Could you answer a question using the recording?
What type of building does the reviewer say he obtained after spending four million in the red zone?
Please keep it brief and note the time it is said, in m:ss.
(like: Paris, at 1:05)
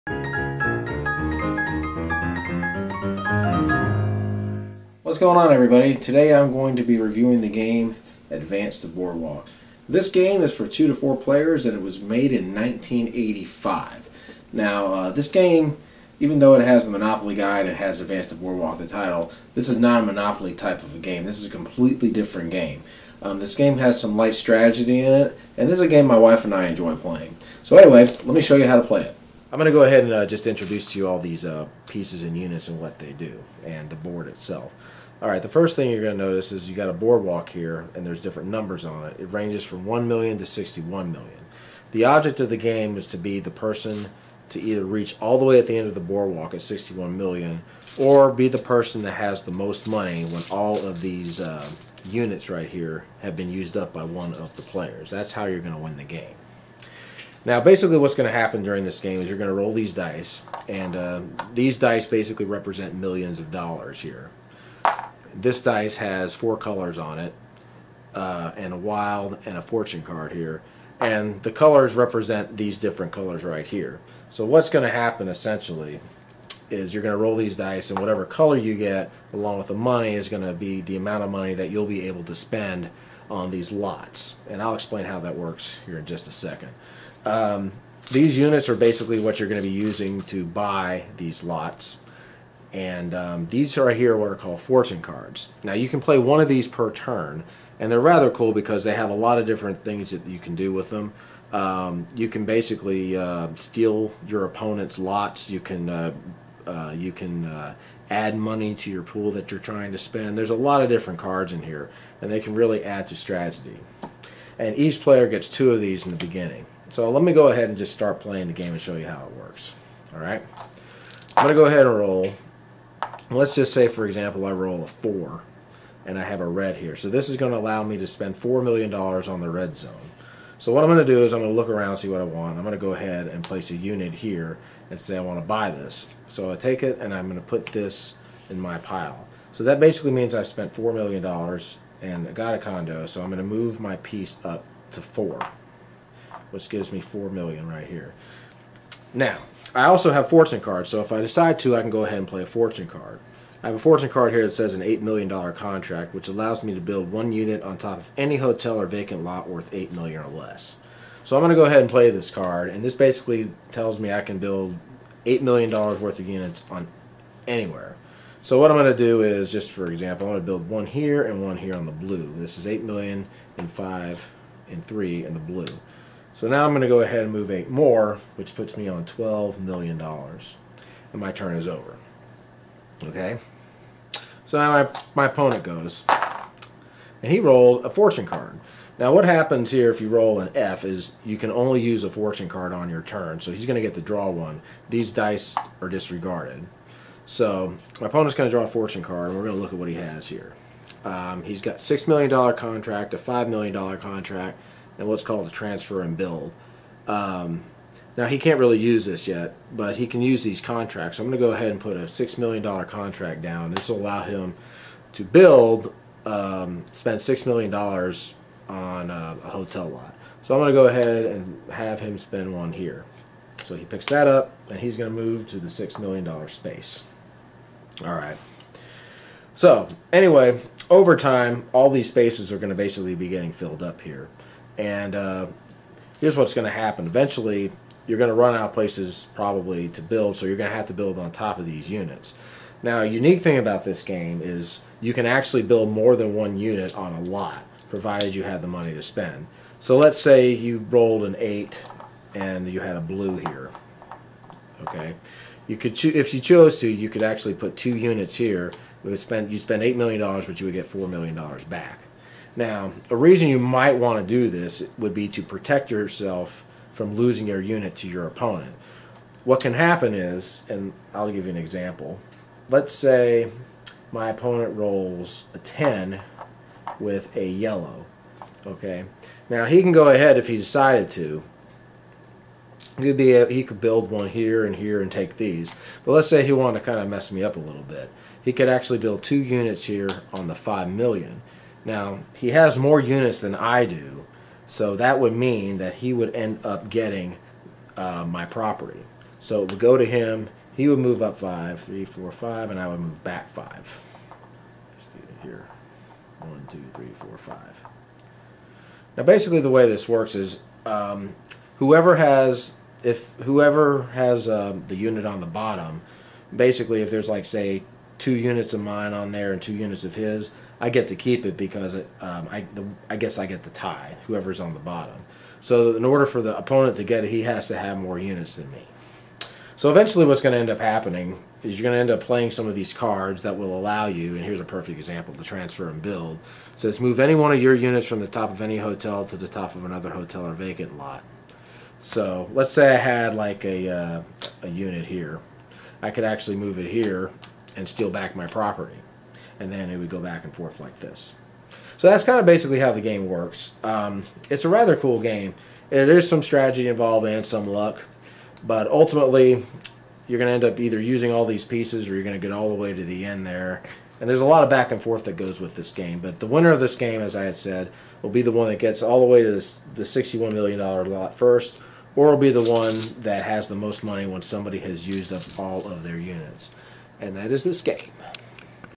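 condo, at 2:22.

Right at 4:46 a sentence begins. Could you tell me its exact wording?
But let's say he wanted to kind of mess me up a little bit.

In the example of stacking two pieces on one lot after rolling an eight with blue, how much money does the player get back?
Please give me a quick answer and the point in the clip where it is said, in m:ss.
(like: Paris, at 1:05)
4 million, at 4:20.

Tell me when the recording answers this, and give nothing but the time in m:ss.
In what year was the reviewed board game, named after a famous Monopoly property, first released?
0:12.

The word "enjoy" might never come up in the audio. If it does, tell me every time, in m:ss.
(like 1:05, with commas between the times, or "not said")
0:26.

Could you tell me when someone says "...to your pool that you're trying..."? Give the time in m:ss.
1:48.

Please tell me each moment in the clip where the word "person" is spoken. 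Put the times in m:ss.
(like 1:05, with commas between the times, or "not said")
0:43, 0:48.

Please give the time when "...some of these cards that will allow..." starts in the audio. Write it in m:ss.
5:32.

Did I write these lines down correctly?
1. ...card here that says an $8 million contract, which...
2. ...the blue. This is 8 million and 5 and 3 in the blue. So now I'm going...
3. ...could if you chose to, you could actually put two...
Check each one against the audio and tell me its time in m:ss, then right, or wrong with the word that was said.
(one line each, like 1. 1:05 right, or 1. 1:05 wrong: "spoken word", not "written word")
1. 2:34 right
2. 2:51 right
3. 4:15 right.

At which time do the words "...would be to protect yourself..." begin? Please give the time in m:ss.
4:24.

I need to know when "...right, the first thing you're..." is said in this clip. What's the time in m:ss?
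0:35.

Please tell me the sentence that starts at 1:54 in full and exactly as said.
And each player gets two of these in the beginning.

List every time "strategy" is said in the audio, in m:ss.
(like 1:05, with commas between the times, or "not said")
0:24, 1:53, 5:56.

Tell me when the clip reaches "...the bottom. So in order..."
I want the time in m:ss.
5:24.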